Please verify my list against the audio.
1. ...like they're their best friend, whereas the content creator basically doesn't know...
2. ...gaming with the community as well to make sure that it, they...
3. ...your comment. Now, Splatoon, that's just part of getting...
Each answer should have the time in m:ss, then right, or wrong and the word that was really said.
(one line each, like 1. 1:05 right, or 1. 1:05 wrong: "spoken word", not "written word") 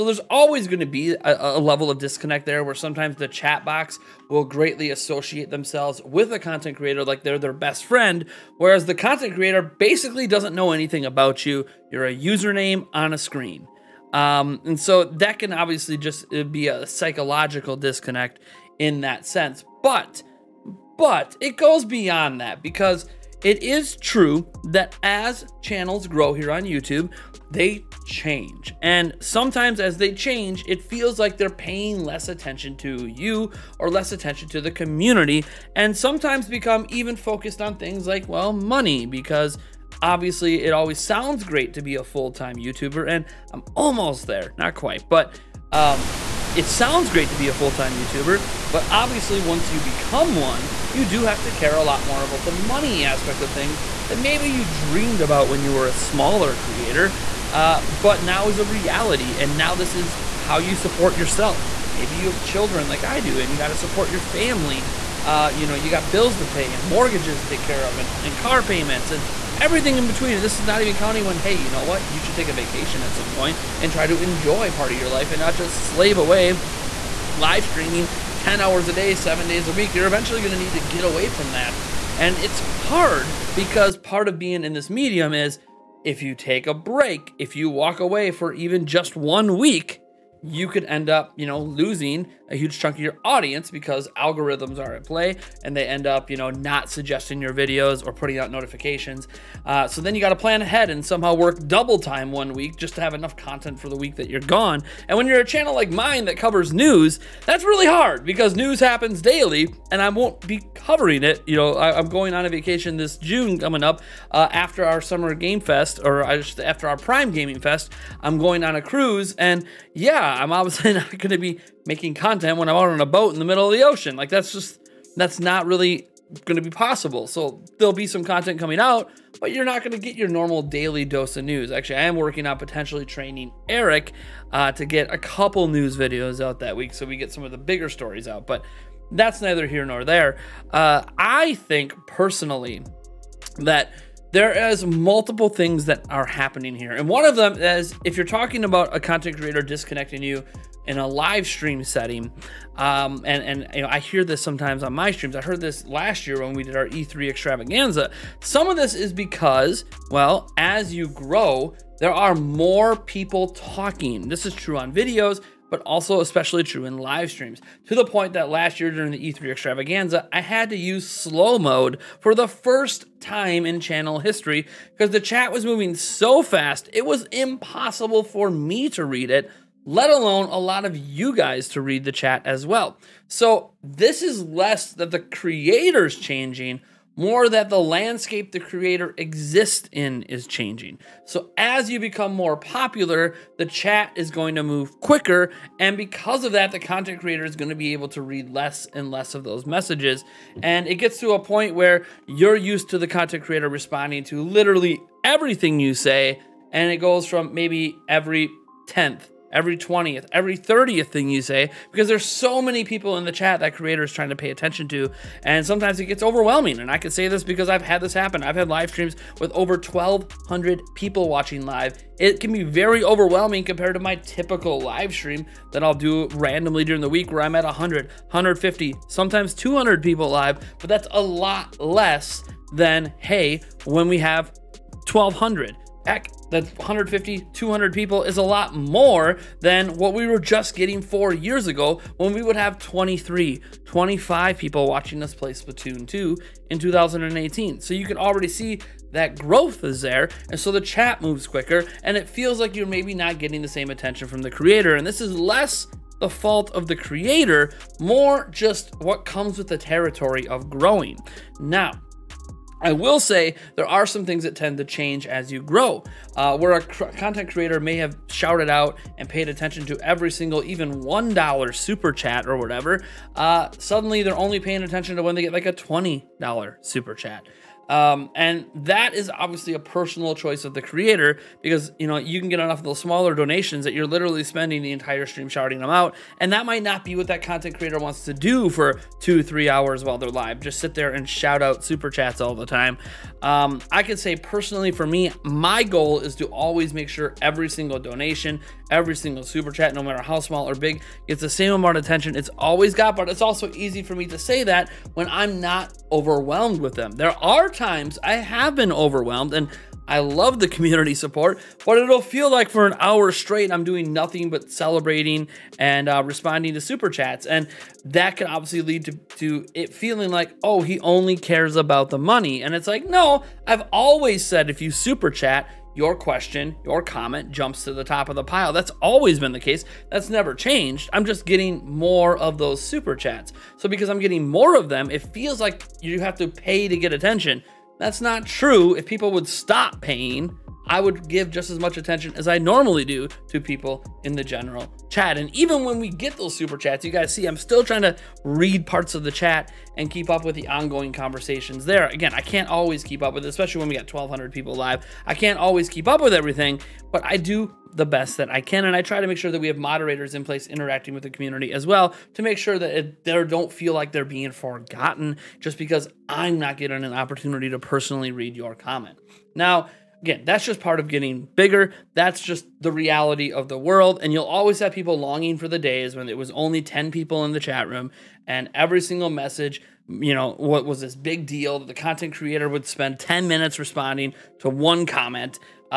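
1. 0:07 right
2. 6:00 wrong: "interacting", not "gaming"
3. 6:08 wrong: "Again", not "Splatoon".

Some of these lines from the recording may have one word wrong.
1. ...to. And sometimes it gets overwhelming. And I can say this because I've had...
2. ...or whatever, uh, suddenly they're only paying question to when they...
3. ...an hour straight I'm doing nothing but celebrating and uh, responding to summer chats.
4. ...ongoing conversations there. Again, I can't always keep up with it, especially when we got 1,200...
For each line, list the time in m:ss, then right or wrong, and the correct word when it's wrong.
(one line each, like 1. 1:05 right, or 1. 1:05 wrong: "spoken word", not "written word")
1. 3:34 right
2. 4:32 wrong: "attention", not "question"
3. 5:12 wrong: "super", not "summer"
4. 5:50 right.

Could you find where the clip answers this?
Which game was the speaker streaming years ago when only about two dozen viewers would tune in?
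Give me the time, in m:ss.
4:05.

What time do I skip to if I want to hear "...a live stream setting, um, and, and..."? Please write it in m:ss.
2:30.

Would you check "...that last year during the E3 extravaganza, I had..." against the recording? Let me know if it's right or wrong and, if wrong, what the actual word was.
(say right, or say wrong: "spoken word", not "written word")
right.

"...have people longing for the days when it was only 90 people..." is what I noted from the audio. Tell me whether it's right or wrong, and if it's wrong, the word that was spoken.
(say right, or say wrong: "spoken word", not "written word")
wrong: "10", not "90".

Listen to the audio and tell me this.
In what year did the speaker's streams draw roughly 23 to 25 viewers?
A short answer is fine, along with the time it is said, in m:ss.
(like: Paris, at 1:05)
2018, at 4:06.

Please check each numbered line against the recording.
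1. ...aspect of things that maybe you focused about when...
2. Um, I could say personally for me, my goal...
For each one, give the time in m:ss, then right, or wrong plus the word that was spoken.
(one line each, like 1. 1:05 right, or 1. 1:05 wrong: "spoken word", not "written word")
1. 0:53 wrong: "dreamed", not "focused"
2. 4:53 right.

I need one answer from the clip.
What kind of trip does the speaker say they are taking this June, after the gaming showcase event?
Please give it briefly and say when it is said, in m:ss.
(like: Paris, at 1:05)
A cruise, at 1:58.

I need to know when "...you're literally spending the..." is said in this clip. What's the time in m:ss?
4:43.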